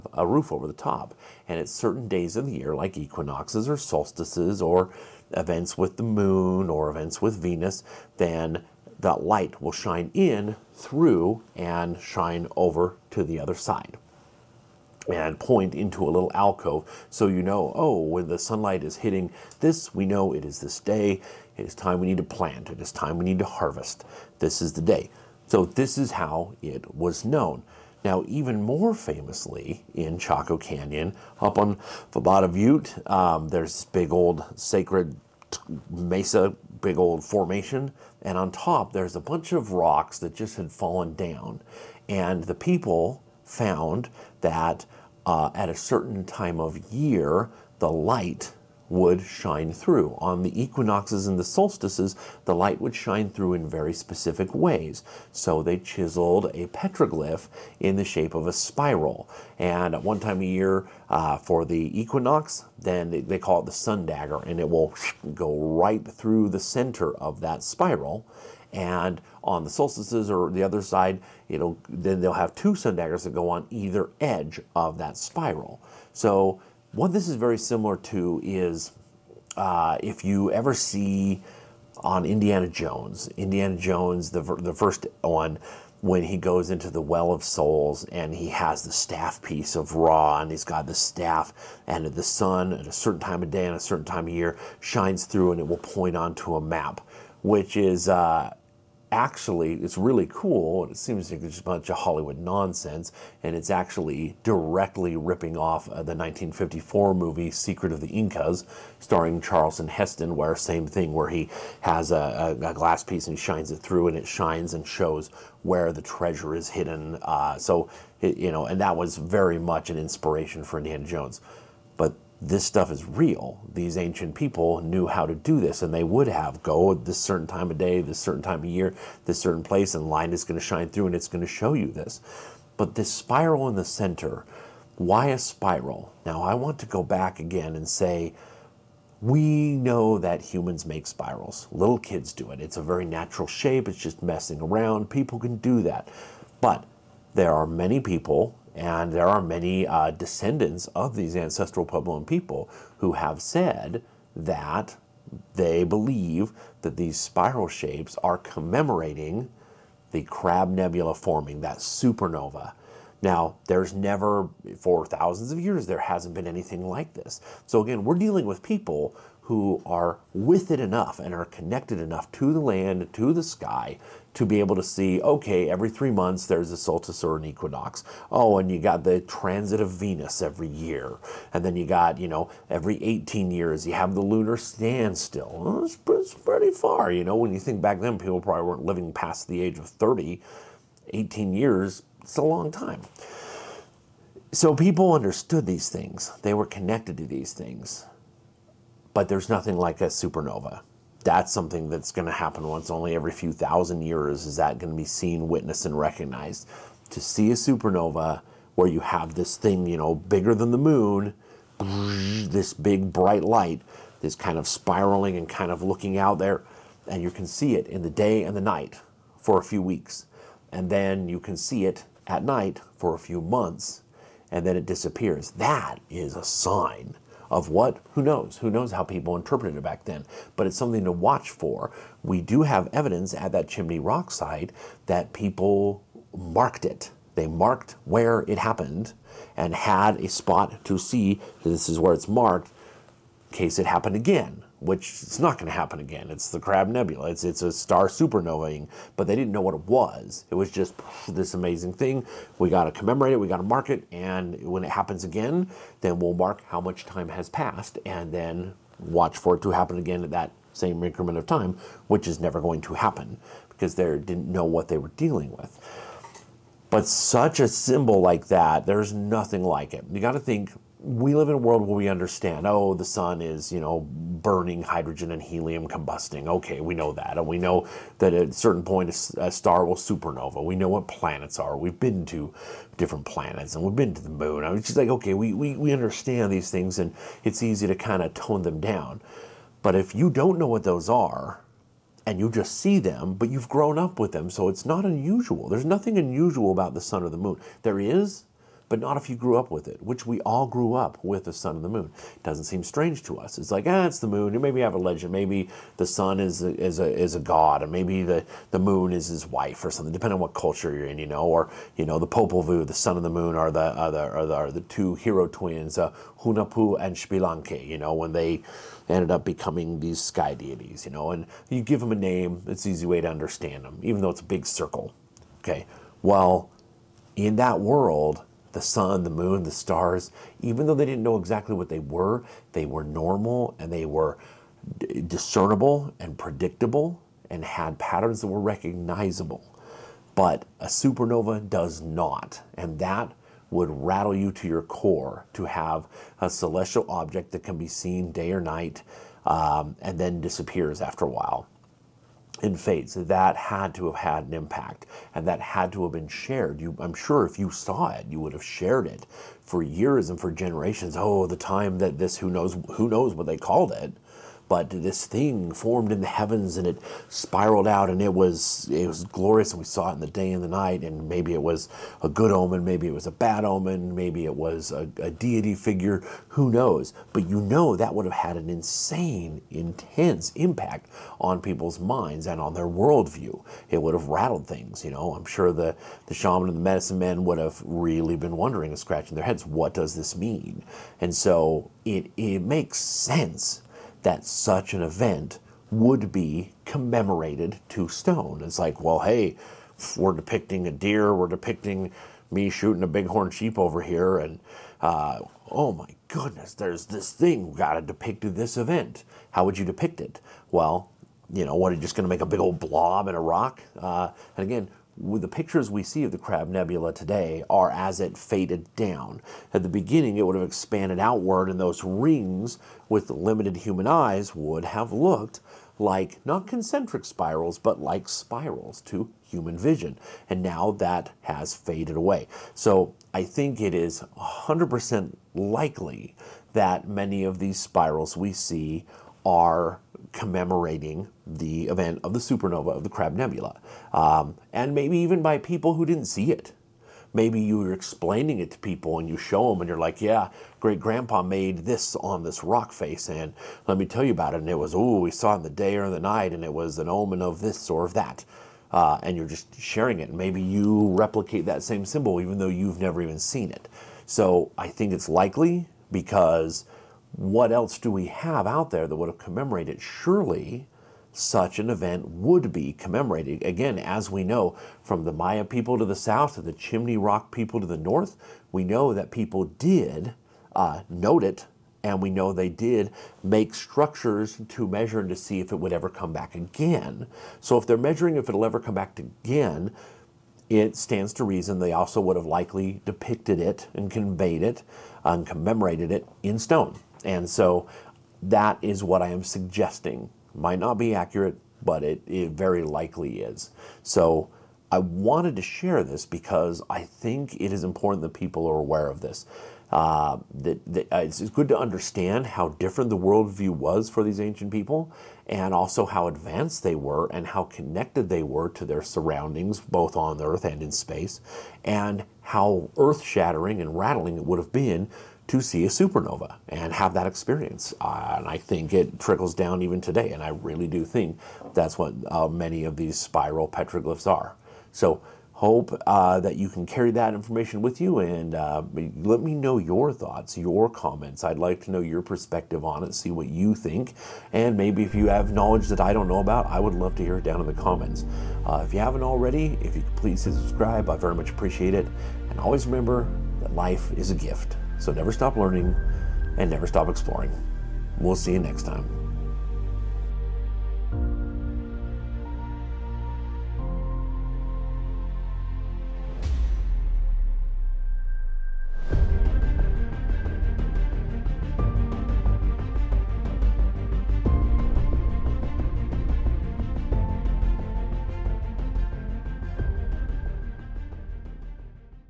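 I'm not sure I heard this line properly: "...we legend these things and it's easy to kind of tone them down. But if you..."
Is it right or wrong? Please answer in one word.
wrong.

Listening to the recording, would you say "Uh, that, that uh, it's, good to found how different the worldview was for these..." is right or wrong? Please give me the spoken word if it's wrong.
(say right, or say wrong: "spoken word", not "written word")
wrong: "understand", not "found".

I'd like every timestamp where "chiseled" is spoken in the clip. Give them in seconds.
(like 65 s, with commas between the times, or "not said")
55 s.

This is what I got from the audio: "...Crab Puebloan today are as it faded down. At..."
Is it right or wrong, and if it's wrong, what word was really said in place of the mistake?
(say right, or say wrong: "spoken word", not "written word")
wrong: "Nebula", not "Puebloan".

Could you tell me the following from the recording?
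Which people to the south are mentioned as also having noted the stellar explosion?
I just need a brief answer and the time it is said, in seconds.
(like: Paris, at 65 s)
Maya, at 475 s.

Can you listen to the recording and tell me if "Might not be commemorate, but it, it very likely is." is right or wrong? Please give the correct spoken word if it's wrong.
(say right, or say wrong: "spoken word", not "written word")
wrong: "accurate", not "commemorate".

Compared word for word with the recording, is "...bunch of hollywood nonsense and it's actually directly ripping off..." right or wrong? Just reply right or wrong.
right.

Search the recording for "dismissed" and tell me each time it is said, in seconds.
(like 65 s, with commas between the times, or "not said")
not said.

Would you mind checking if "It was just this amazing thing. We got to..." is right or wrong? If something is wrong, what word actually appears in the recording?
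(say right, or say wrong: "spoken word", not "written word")
right.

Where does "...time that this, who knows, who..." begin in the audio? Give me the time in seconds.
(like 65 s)
361 s.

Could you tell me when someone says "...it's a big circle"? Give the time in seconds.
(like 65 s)
324 s.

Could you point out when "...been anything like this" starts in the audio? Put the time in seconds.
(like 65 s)
166 s.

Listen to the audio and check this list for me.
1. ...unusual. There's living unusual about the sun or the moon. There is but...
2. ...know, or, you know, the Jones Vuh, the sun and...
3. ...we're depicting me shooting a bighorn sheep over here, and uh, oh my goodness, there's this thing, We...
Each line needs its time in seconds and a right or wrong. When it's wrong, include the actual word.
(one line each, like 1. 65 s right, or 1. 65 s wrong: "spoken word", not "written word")
1. 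295 s wrong: "nothing", not "living"
2. 311 s wrong: "Popol", not "Jones"
3. 401 s right.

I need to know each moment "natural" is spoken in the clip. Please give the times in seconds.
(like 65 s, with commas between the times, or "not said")
143 s.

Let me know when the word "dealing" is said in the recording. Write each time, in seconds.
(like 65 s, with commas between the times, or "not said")
168 s, 265 s.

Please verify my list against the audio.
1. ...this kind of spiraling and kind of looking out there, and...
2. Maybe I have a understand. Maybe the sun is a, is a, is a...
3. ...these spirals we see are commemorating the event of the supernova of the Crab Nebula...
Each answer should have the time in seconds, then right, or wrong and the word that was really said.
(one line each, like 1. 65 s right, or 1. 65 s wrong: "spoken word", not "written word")
1. 214 s right
2. 304 s wrong: "legend", not "understand"
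3. 437 s right.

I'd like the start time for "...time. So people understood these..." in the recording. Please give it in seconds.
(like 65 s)
192 s.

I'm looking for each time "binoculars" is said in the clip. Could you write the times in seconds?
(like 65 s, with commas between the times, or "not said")
not said.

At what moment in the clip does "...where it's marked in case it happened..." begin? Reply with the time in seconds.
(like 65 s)
241 s.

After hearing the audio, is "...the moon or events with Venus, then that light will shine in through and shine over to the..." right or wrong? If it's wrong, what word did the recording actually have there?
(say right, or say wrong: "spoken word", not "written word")
right.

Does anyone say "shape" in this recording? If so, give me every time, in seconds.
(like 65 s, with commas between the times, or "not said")
58 s, 143 s, 157 s.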